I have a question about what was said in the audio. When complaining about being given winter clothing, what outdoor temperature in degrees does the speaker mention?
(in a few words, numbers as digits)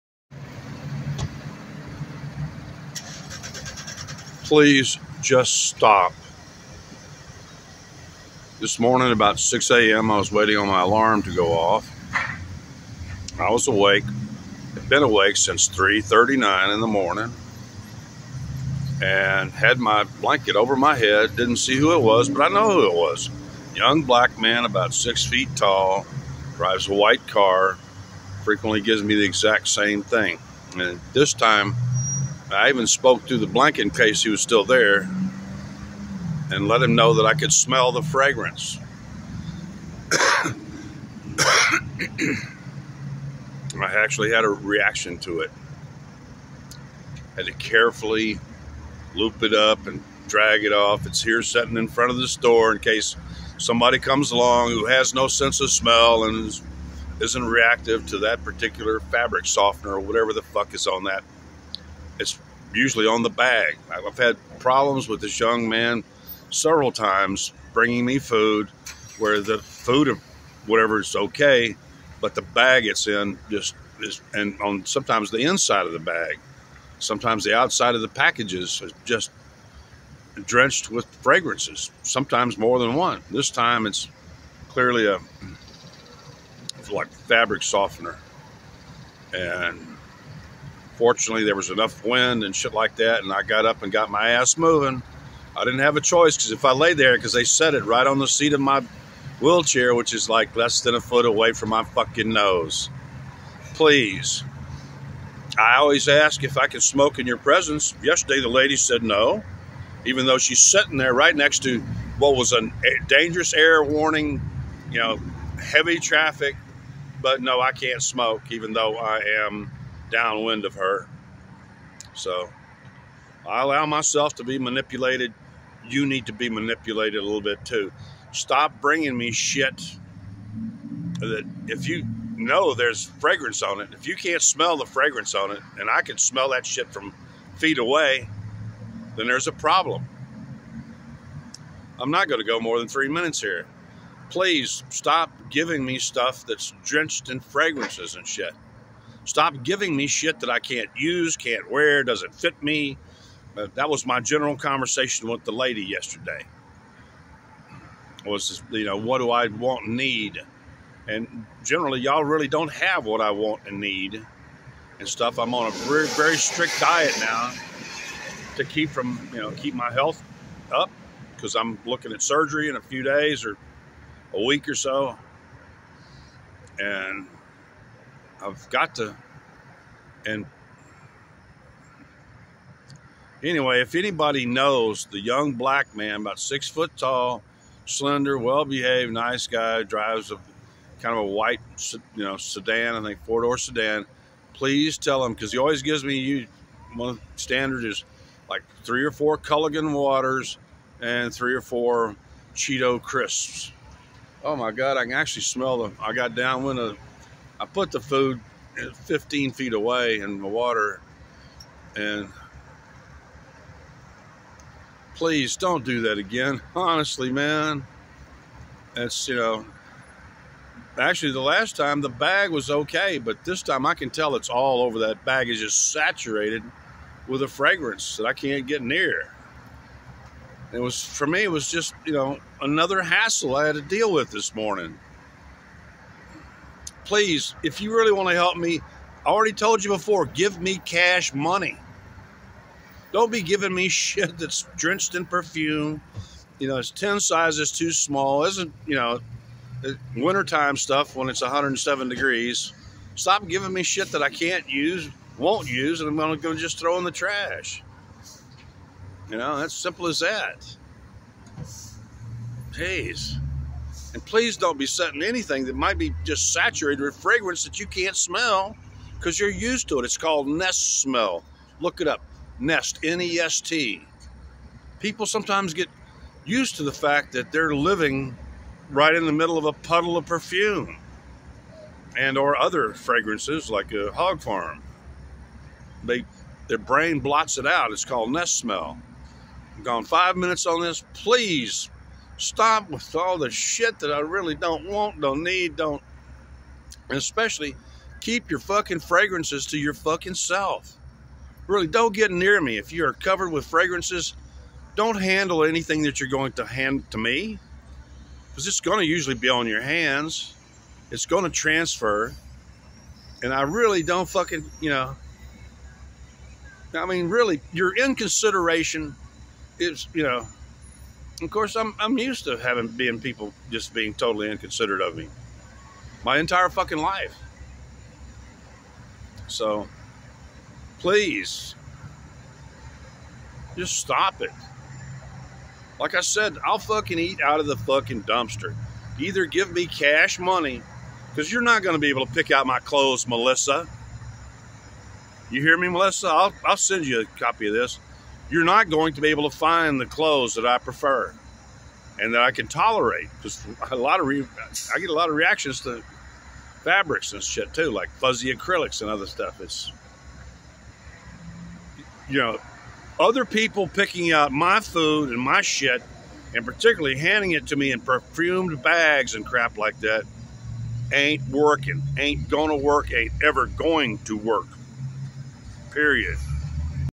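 107.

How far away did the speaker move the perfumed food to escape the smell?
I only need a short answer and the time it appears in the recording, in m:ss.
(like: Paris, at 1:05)
15 feet, at 3:29.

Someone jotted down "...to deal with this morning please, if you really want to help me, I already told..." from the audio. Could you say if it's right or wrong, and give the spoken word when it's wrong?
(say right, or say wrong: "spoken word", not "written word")
right.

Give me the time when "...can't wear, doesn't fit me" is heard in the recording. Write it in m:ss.
2:31.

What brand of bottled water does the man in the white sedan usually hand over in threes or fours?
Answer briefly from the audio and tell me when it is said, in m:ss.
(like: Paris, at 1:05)
Culligan, at 3:19.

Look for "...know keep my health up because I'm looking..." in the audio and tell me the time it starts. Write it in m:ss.
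2:49.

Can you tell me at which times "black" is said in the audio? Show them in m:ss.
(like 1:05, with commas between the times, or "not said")
0:24, 3:05.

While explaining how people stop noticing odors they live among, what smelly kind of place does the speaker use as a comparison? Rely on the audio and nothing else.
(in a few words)
A hog farm.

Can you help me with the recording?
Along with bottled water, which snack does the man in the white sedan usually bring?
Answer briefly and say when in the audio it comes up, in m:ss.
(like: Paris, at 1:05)
Cheeto crisps, at 3:22.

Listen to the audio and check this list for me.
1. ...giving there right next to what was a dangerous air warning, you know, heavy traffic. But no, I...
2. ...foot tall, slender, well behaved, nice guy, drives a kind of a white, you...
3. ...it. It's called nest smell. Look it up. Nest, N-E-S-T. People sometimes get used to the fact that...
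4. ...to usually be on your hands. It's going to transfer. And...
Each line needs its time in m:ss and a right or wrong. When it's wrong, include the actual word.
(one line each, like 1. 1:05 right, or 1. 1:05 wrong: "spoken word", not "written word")
1. 1:50 wrong: "sitting", not "giving"
2. 3:06 right
3. 4:29 right
4. 5:08 right.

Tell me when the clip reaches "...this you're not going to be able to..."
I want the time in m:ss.
5:47.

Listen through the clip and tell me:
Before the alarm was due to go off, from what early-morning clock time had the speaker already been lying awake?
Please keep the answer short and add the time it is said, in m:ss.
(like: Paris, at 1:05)
3:39, at 0:15.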